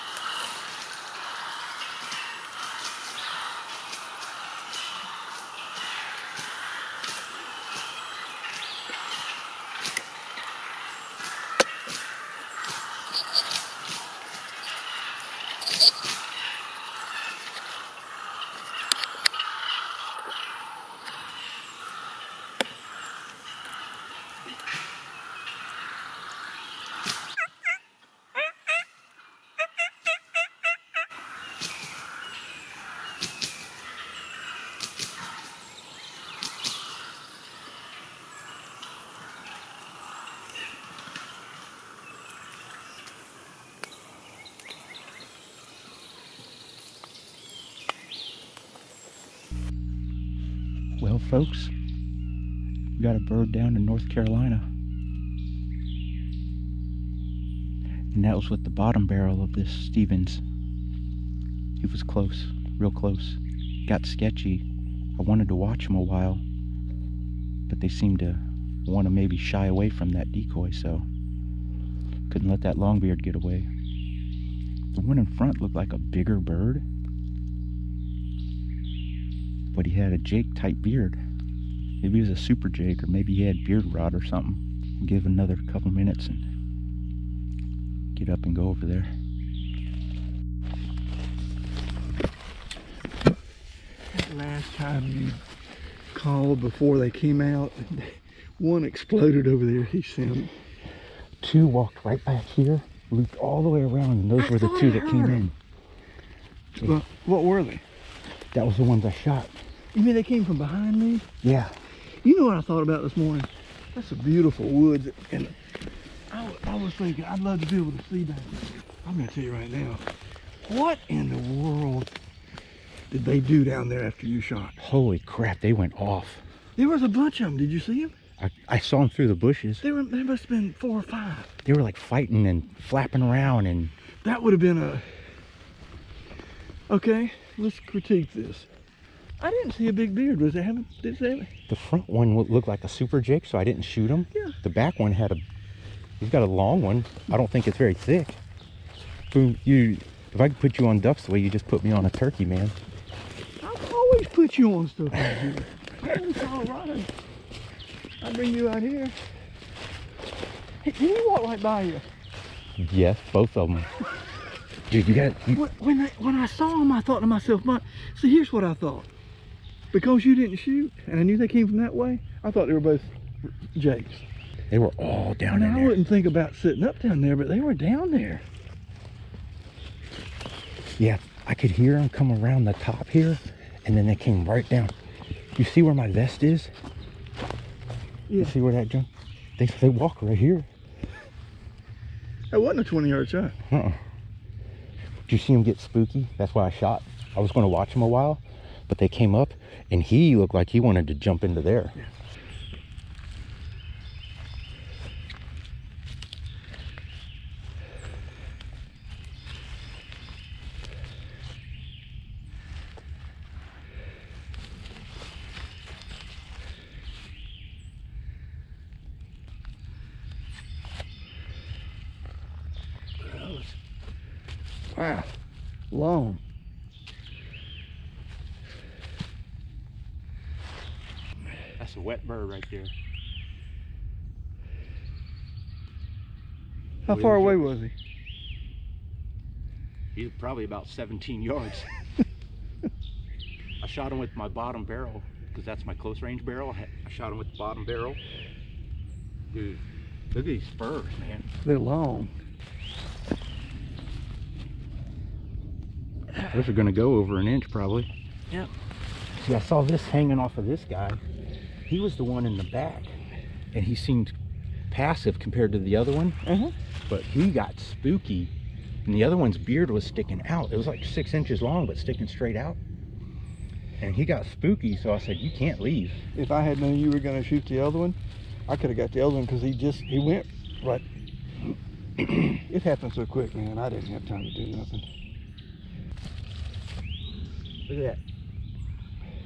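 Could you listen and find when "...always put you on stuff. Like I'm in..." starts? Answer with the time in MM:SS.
02:33.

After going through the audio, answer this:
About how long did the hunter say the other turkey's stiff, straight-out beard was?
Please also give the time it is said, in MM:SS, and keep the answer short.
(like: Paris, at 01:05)
6 inches, at 04:31.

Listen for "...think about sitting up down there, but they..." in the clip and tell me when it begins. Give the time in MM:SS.
02:56.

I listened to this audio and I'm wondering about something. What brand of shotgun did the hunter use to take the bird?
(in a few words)
Stevens.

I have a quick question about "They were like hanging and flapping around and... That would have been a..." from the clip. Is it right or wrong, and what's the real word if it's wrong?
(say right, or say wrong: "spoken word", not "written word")
wrong: "fighting", not "hanging".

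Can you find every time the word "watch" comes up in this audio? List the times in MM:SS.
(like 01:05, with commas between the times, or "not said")
01:05, 03:17.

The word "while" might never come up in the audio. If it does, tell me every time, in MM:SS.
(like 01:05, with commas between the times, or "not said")
01:06, 03:18.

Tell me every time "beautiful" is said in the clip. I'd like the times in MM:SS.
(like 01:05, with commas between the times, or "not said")
01:54.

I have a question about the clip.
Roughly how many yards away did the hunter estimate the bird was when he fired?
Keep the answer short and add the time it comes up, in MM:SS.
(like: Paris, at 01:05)
17, at 04:00.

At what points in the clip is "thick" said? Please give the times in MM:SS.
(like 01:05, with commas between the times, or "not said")
02:27.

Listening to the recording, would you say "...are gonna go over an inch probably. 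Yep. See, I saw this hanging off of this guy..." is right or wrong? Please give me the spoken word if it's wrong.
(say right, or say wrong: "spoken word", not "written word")
right.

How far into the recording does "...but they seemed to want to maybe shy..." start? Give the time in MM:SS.
01:07.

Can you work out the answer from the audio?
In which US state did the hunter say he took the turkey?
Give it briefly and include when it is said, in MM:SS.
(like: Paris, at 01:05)
North Carolina, at 00:53.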